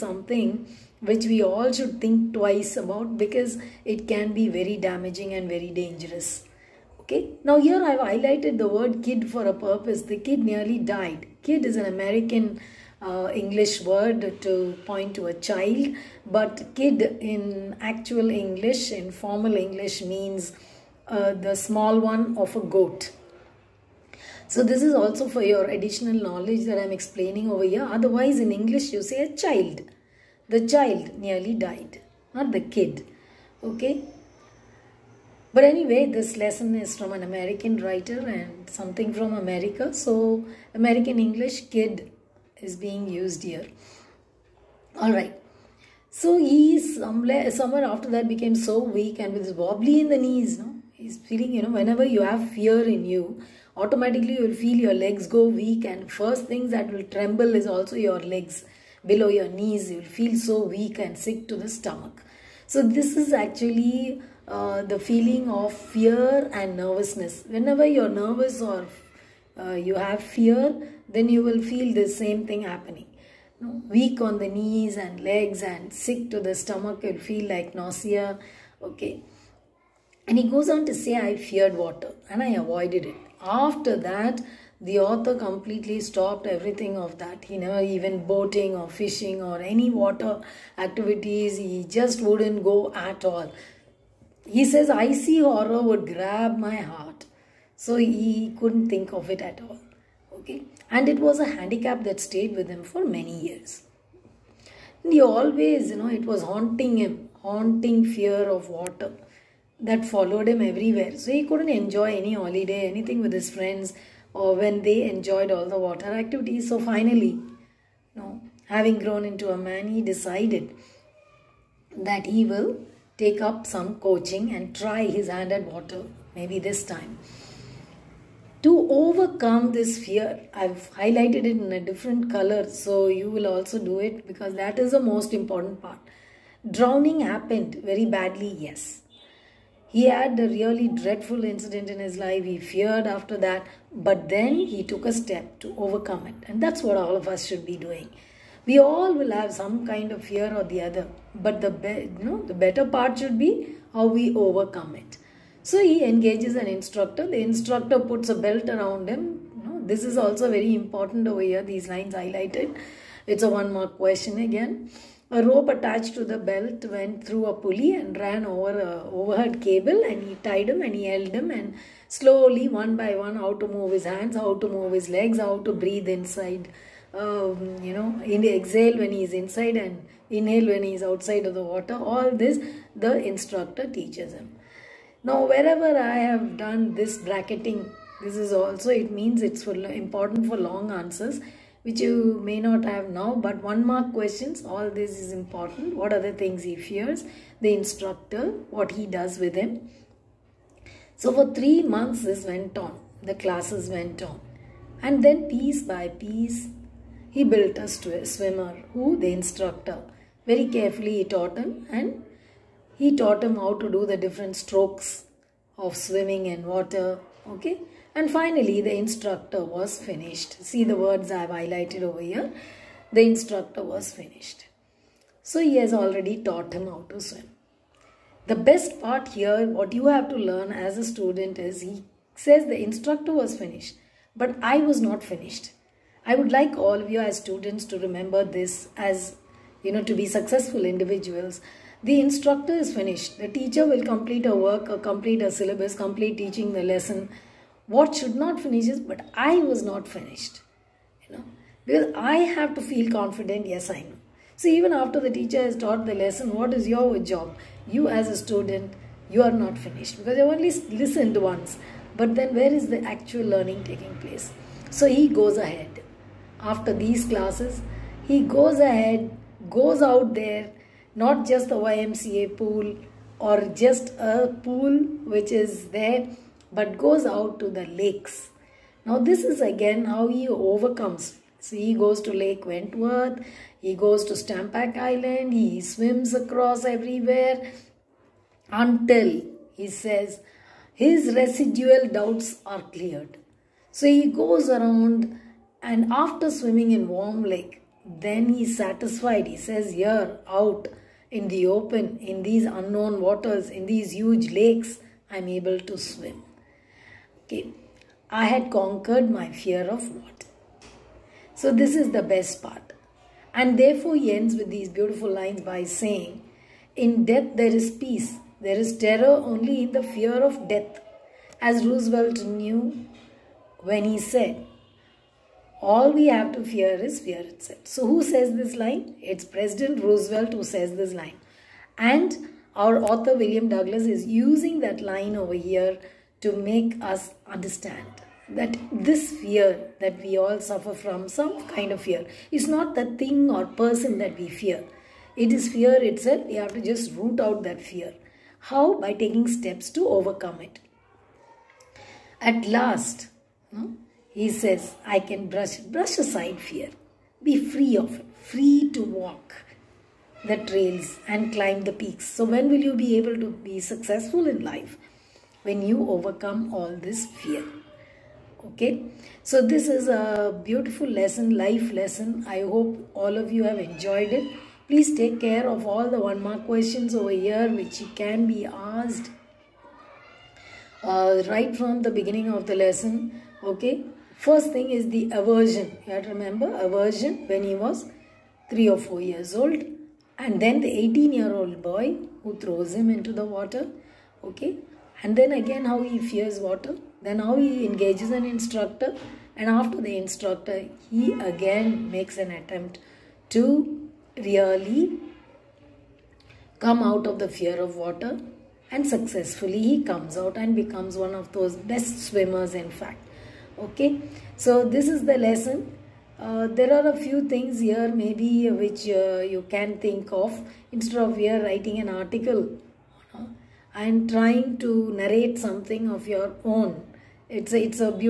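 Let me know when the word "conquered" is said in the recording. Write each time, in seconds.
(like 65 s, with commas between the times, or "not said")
308 s.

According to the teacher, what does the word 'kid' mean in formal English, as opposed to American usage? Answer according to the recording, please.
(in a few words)
The small one of a goat.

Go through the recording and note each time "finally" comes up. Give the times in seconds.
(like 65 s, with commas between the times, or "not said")
116 s, 218 s.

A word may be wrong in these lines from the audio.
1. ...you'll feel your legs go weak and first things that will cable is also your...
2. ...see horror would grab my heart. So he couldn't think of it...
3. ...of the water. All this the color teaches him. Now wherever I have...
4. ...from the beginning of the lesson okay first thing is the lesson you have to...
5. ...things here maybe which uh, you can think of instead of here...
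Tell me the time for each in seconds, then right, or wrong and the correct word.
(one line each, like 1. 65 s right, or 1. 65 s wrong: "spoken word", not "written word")
1. 54 s wrong: "tremble", not "cable"
2. 95 s right
3. 181 s wrong: "instructor", not "color"
4. 381 s wrong: "aversion", not "lesson"
5. 417 s right.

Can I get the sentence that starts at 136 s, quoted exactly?
Drowning happened very badly, yes he had a really dreadful incident in his life.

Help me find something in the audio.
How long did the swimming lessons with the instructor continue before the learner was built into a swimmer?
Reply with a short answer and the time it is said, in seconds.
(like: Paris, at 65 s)
3 months, at 201 s.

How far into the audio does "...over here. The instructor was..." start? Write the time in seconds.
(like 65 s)
222 s.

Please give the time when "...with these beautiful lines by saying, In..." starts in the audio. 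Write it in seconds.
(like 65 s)
314 s.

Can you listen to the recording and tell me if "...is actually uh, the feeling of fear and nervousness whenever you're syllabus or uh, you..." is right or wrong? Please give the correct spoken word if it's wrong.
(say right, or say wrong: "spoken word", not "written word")
wrong: "nervous", not "syllabus".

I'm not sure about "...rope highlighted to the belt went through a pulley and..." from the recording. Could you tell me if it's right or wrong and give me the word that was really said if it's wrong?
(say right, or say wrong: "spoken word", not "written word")
wrong: "attached", not "highlighted".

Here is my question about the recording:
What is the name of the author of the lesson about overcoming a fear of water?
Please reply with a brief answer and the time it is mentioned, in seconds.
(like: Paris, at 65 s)
William Douglas, at 333 s.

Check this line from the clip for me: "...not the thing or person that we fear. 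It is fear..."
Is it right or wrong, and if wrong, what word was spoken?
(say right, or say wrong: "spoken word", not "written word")
right.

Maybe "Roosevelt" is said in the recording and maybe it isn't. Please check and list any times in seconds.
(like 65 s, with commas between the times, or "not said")
321 s, 330 s.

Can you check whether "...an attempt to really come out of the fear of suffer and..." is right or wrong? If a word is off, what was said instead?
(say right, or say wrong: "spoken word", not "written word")
wrong: "water", not "suffer".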